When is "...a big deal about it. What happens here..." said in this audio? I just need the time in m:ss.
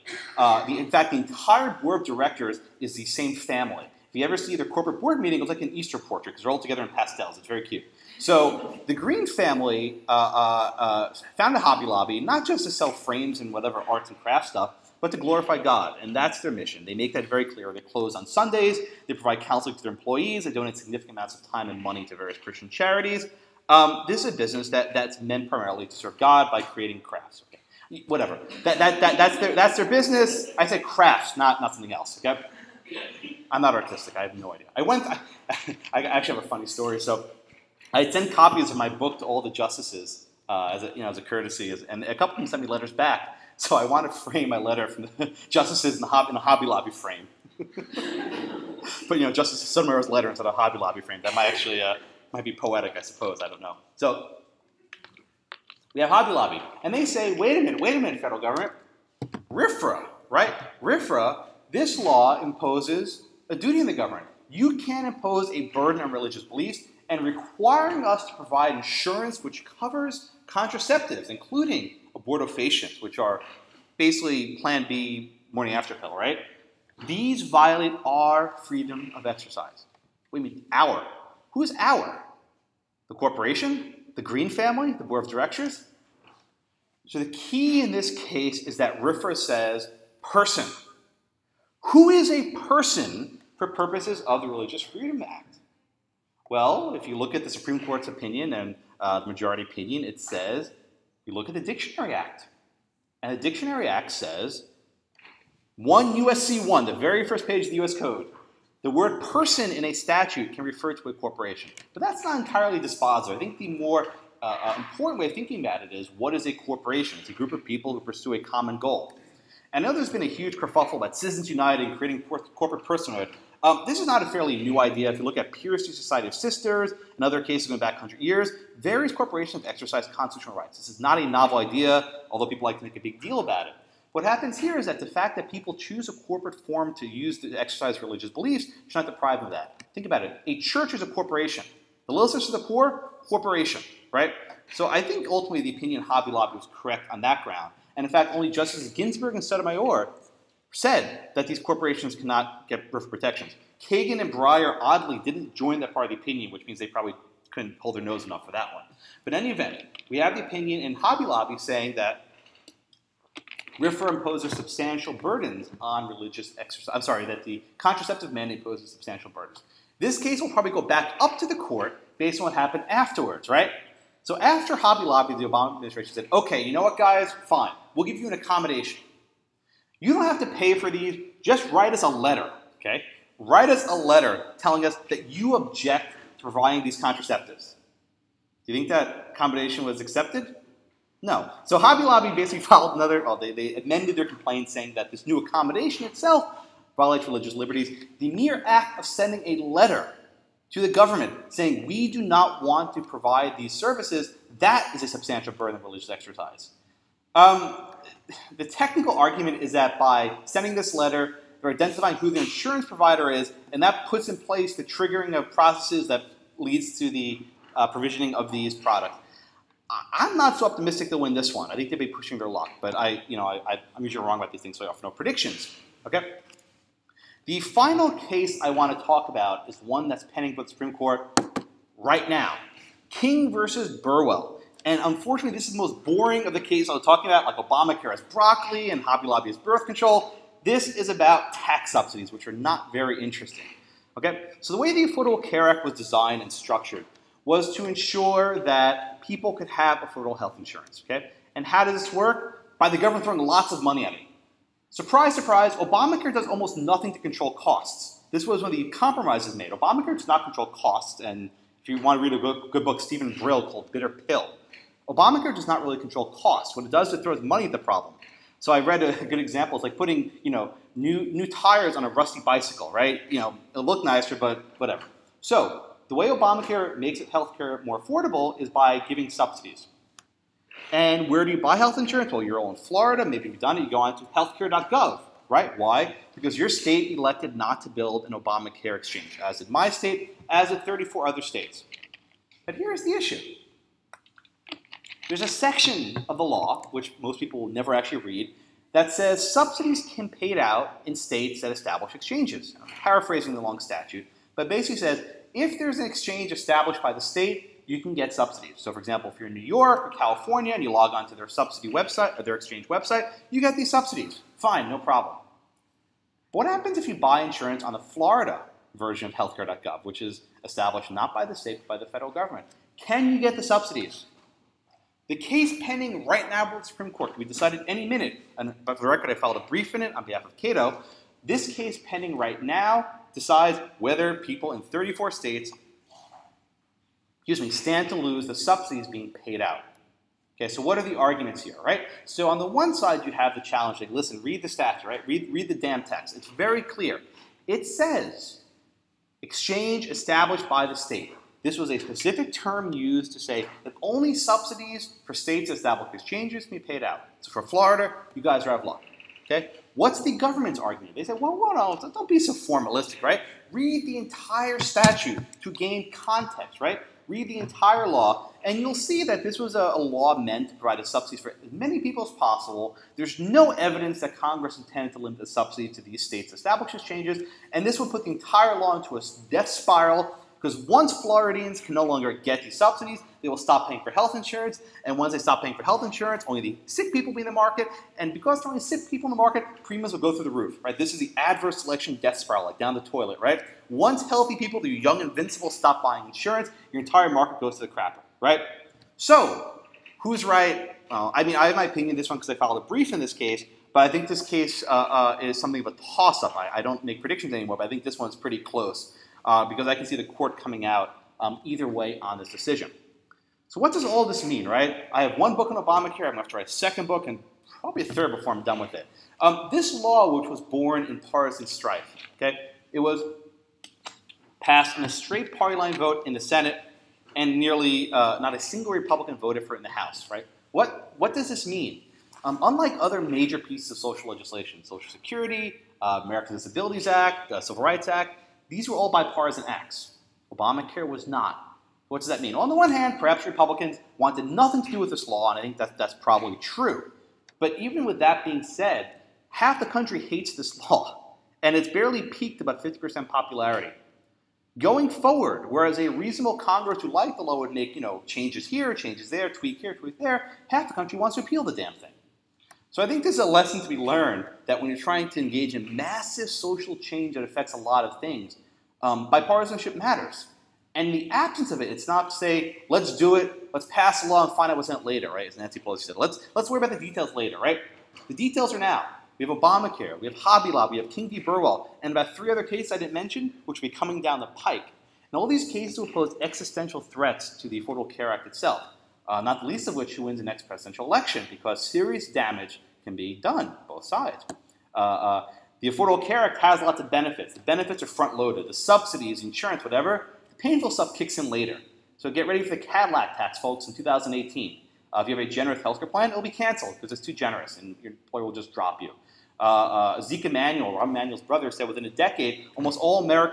2:12.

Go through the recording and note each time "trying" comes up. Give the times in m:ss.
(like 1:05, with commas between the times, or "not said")
7:44.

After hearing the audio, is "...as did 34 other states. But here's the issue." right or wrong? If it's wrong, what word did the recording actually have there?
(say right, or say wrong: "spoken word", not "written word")
right.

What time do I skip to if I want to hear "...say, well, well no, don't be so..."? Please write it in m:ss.
6:01.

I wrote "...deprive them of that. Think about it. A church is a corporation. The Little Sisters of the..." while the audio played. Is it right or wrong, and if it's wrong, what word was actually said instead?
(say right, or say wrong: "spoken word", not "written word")
right.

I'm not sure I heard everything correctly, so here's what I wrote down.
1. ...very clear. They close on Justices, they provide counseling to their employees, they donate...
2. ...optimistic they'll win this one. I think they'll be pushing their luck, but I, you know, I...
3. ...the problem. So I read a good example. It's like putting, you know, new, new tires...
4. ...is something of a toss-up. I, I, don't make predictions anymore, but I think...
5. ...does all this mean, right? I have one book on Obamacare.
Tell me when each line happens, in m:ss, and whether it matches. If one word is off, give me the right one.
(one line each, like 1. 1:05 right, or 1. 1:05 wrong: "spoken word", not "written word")
1. 0:17 wrong: "Sundays", not "Justices"
2. 3:40 right
3. 4:27 right
4. 6:45 right
5. 6:53 right.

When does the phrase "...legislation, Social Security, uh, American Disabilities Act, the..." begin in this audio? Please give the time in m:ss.
7:14.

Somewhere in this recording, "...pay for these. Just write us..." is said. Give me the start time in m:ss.
3:00.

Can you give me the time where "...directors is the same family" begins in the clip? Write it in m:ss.
0:02.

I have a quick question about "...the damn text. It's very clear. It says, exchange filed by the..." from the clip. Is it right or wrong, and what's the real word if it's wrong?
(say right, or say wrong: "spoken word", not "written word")
wrong: "established", not "filed".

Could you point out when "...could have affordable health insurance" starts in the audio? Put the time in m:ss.
4:09.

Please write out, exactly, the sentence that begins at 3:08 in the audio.
Do you think that accommodation was accepted?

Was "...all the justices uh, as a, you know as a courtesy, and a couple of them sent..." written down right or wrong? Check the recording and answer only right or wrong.
right.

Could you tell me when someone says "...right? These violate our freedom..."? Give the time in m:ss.
1:16.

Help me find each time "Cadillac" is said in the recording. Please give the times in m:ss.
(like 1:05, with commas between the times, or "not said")
8:22.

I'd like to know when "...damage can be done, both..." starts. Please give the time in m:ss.
8:12.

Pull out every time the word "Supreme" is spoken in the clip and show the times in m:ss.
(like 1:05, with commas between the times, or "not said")
1:37, 3:50, 5:26.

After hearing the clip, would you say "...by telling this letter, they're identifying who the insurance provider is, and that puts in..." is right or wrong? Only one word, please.
wrong.